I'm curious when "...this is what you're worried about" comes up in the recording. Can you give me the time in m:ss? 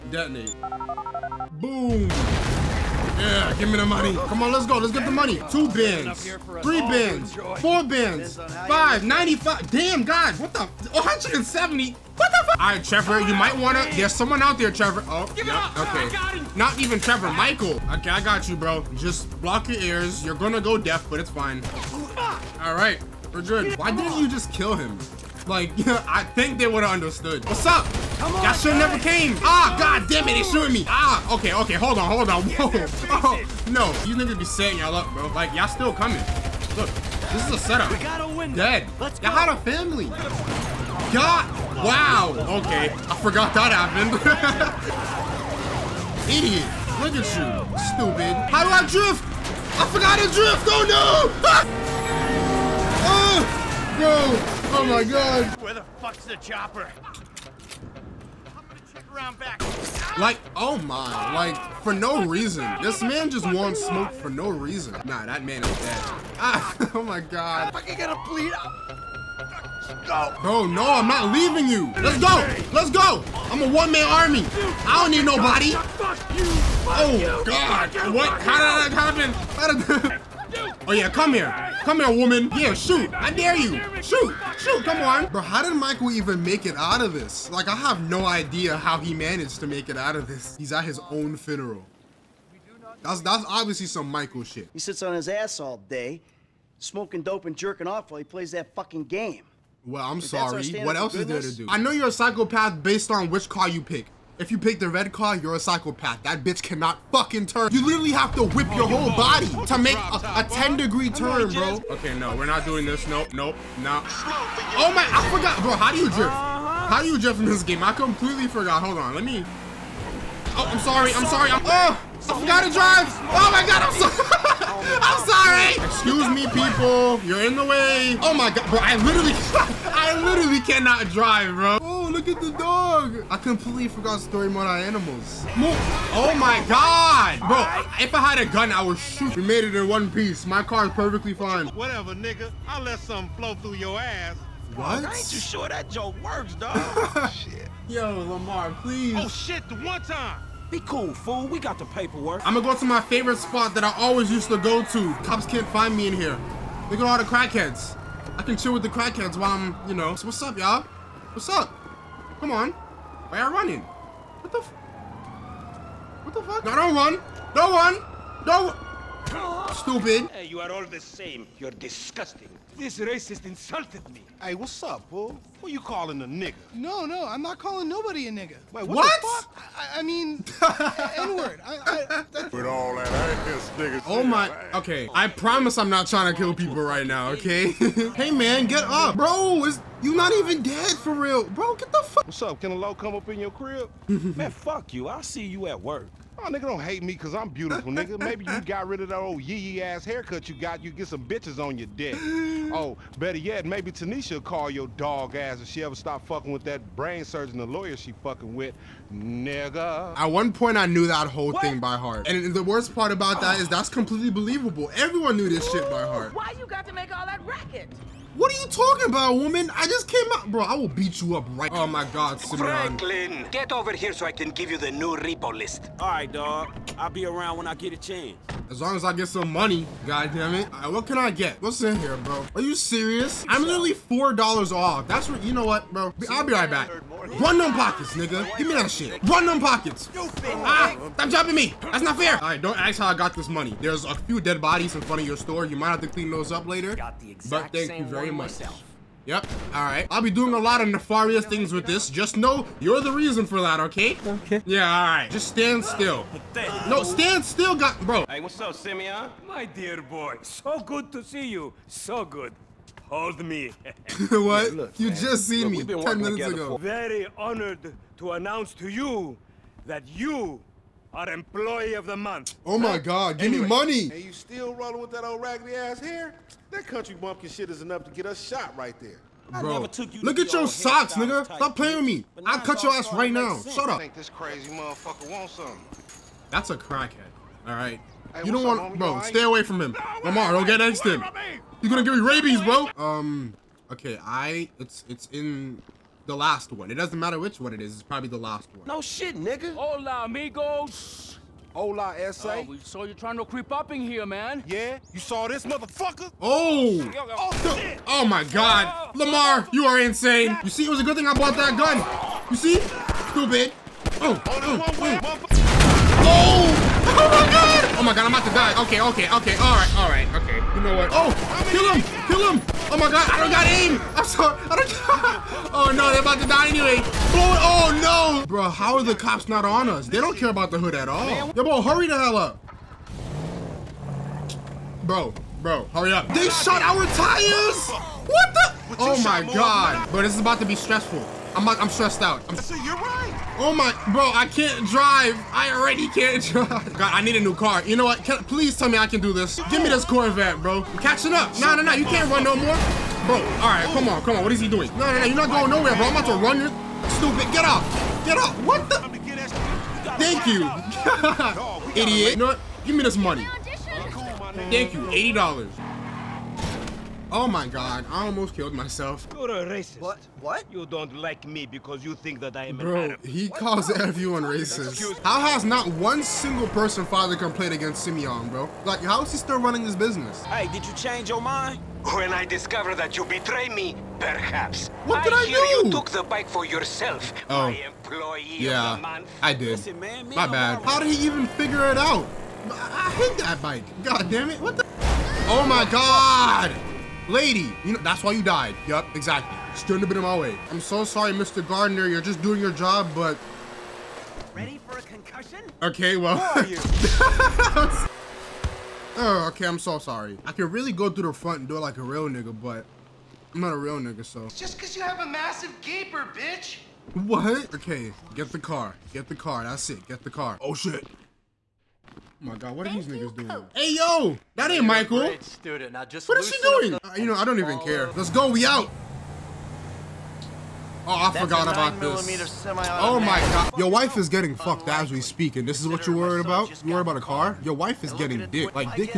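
7:15.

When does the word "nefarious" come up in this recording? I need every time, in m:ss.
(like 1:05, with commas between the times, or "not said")
4:10.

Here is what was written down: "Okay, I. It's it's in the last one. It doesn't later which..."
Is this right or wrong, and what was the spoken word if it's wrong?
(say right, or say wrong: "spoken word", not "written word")
wrong: "matter", not "later".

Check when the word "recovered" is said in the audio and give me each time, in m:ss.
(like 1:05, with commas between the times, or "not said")
not said.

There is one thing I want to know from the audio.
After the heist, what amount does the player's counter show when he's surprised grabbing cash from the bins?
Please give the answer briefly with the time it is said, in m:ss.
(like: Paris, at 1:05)
170, at 0:10.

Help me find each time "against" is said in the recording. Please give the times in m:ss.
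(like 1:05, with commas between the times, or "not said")
6:17.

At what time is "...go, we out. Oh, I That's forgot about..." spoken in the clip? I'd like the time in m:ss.
7:08.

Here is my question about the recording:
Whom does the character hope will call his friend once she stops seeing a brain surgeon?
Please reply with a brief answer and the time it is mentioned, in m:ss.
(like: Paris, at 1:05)
Tanisha, at 3:23.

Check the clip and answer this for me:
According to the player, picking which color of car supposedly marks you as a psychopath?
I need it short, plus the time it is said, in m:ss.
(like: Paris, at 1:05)
Red, at 1:44.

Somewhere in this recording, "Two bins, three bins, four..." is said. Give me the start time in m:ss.
0:05.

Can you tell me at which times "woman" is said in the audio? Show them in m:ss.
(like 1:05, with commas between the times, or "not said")
1:22, 3:39.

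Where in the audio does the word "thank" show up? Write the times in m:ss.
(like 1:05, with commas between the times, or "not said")
4:07, 6:00, 6:04.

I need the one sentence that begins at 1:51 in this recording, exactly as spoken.
Okay, no, we're not doing this.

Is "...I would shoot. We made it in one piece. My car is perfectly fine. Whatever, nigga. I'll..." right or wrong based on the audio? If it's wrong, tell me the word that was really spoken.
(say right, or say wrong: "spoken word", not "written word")
right.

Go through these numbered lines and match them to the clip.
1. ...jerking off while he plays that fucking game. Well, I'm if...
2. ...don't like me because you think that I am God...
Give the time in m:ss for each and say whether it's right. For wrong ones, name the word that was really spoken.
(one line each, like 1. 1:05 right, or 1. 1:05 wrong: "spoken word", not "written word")
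1. 1:37 right
2. 6:10 wrong: "Bro", not "God".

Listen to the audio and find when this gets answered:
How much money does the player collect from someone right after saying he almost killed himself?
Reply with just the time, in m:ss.
6:05.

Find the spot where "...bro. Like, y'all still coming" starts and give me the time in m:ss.
0:35.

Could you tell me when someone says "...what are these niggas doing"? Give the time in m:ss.
7:02.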